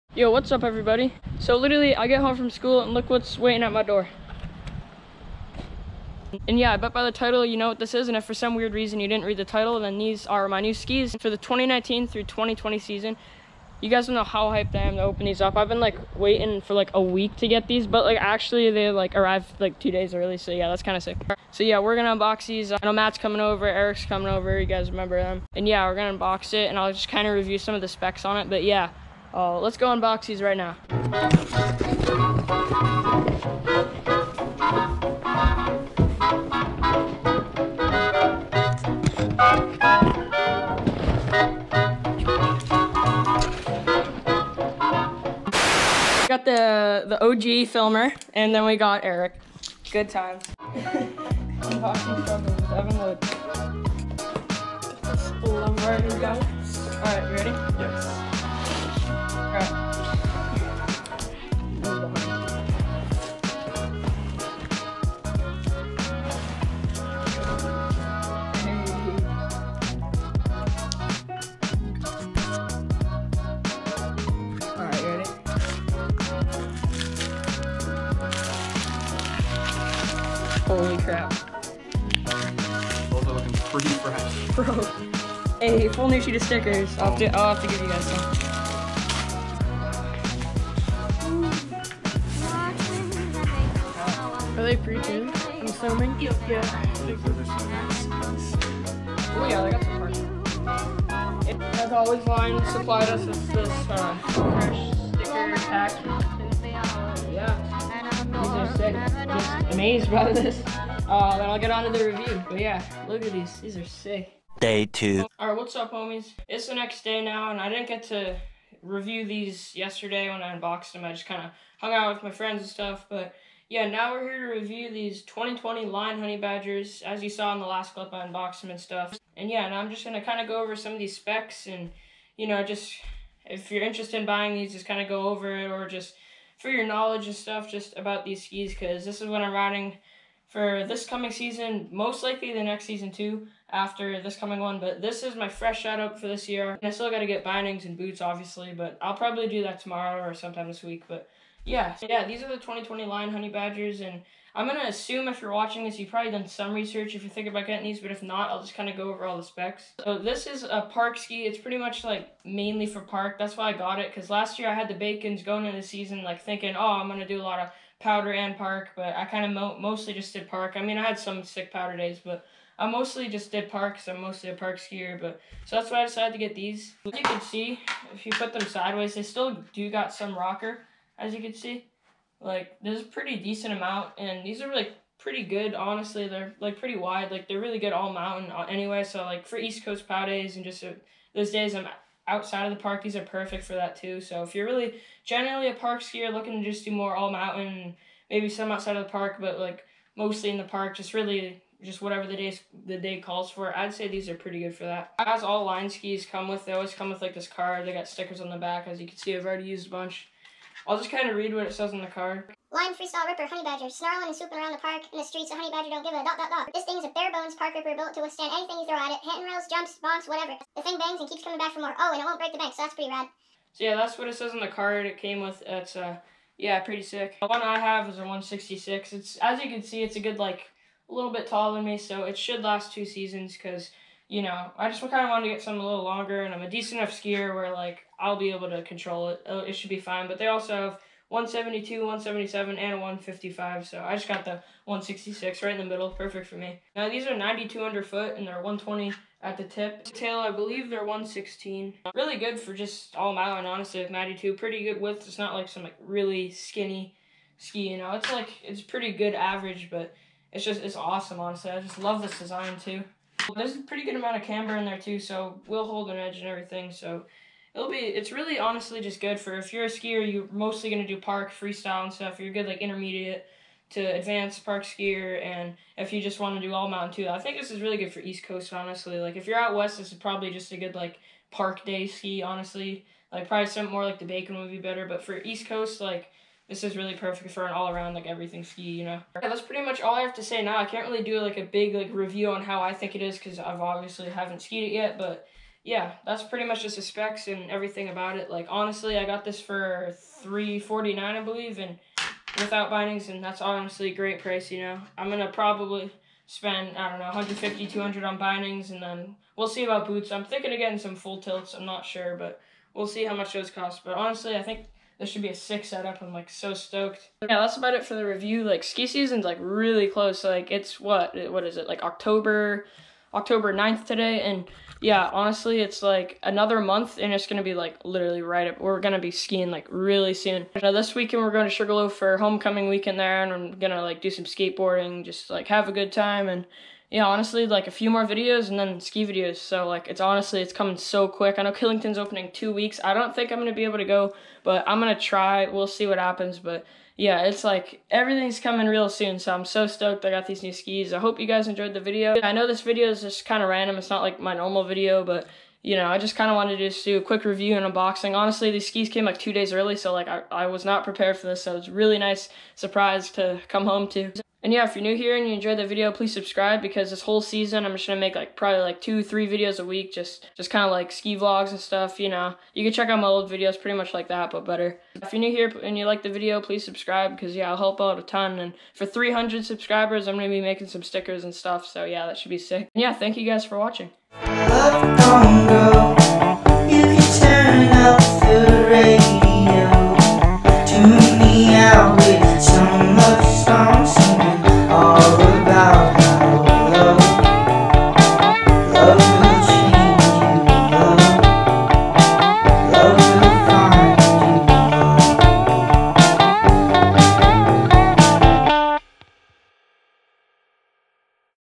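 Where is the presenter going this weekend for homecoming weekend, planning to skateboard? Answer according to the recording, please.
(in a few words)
Sugarloaf.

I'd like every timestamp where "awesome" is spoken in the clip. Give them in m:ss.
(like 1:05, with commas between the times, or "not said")
4:20.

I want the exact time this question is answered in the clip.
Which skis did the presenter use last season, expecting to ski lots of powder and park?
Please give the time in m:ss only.
2:44.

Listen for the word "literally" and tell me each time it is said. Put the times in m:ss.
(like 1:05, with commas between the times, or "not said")
0:01, 5:28.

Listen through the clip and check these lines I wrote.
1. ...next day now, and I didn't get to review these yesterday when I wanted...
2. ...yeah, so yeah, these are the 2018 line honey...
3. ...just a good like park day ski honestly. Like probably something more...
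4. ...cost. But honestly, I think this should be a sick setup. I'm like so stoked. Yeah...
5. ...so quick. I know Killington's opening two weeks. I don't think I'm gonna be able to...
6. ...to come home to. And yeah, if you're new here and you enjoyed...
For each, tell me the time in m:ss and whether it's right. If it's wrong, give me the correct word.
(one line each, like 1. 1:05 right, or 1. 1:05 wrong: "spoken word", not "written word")
1. 1:56 wrong: "unboxed", not "wanted"
2. 2:31 wrong: "2020", not "2018"
3. 4:40 right
4. 5:13 right
5. 5:40 right
6. 6:03 right.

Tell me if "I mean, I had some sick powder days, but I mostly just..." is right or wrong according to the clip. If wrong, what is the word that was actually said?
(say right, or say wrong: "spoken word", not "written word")
right.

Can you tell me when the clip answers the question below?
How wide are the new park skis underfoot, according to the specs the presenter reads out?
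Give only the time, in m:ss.
4:07.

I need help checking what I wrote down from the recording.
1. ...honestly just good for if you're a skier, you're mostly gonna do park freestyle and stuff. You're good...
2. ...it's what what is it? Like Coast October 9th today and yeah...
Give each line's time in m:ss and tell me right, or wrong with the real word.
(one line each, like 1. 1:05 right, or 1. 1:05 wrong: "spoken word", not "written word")
1. 4:28 right
2. 5:20 wrong: "October", not "Coast".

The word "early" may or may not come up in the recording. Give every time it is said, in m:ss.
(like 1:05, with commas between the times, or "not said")
0:20, 5:59.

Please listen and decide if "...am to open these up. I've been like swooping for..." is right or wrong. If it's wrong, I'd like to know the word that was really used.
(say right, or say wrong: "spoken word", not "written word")
wrong: "waiting", not "swooping".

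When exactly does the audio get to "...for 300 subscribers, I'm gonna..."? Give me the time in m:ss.
6:18.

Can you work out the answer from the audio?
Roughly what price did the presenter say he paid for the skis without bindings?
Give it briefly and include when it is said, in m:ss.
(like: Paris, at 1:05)
$349, at 5:00.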